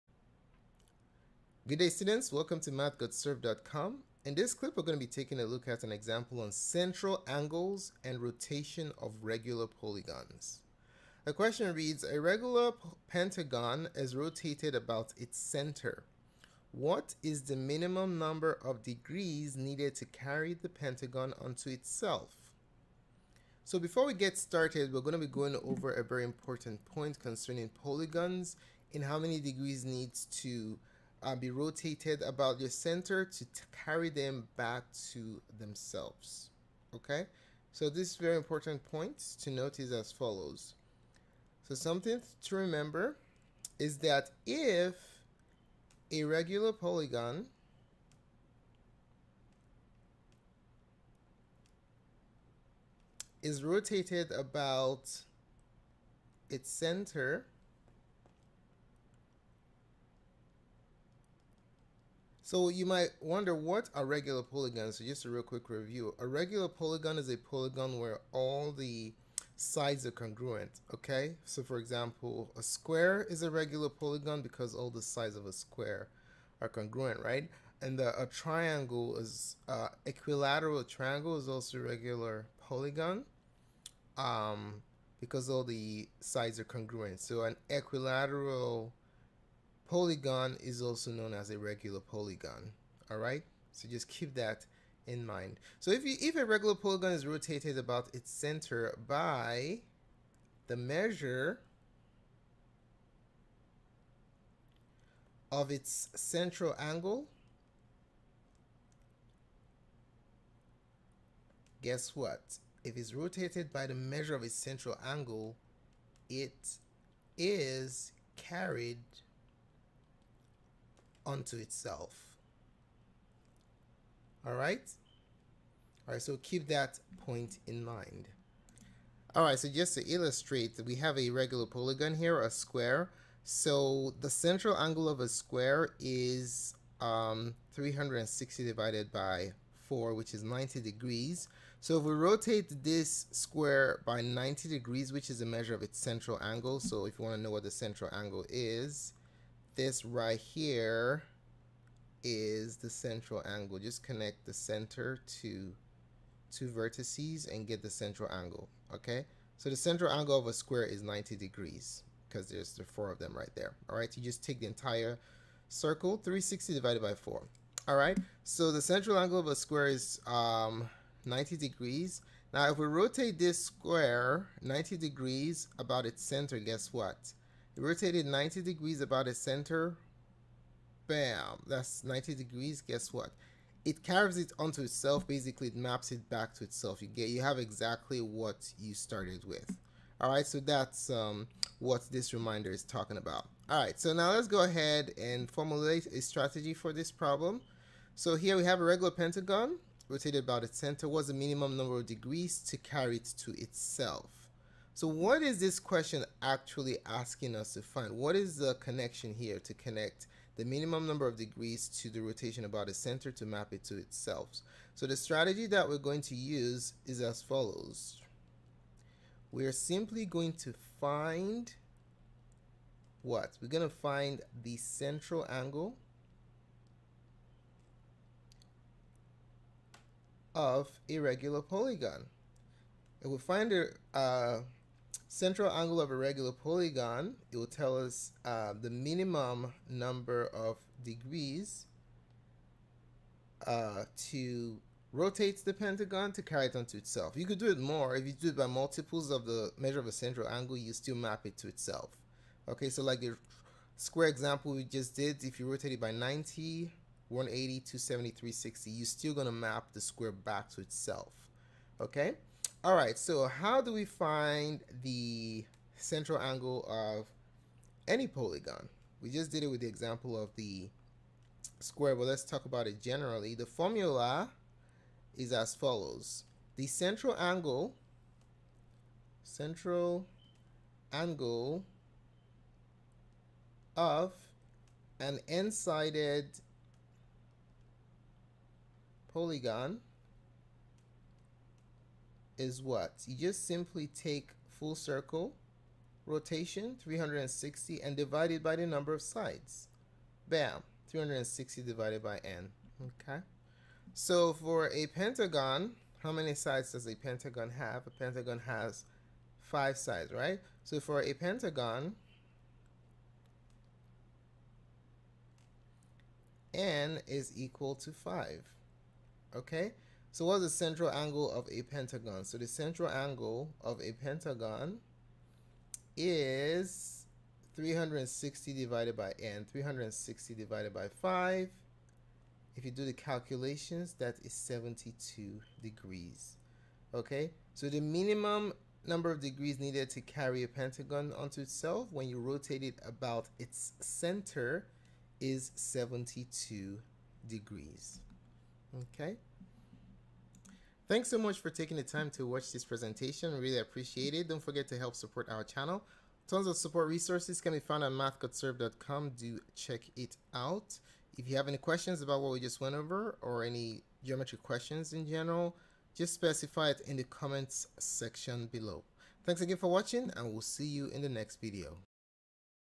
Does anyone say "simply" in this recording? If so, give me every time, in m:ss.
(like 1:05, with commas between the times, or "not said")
3:39, 4:53.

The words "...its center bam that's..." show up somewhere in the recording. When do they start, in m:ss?
2:59.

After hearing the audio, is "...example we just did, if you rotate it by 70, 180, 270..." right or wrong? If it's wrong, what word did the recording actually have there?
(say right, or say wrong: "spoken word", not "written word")
wrong: "90", not "70".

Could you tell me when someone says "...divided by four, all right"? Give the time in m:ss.
2:46.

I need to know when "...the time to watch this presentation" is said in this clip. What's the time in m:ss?
5:51.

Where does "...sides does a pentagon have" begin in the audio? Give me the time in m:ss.
5:06.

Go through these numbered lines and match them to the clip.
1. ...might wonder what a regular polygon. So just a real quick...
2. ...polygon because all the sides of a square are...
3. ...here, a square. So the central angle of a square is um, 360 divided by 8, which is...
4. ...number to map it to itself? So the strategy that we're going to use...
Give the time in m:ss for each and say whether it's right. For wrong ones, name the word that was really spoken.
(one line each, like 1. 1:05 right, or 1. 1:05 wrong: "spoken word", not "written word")
1. 1:02 right
2. 1:13 right
3. 2:12 wrong: "4", not "8"
4. 3:32 wrong: "center", not "number".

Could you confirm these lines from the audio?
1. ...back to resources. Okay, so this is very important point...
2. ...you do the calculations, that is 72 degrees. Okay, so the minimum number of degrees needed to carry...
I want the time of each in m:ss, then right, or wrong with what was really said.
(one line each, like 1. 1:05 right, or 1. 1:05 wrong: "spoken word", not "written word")
1. 0:34 wrong: "themselves", not "resources"
2. 5:32 right.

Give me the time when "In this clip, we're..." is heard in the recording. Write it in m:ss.
0:04.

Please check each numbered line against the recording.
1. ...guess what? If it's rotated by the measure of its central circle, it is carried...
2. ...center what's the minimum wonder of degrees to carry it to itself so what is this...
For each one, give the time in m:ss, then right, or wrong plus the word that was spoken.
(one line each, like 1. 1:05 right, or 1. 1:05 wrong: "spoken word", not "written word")
1. 1:51 wrong: "angle", not "circle"
2. 3:20 wrong: "number", not "wonder".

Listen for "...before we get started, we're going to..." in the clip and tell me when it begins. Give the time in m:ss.
0:23.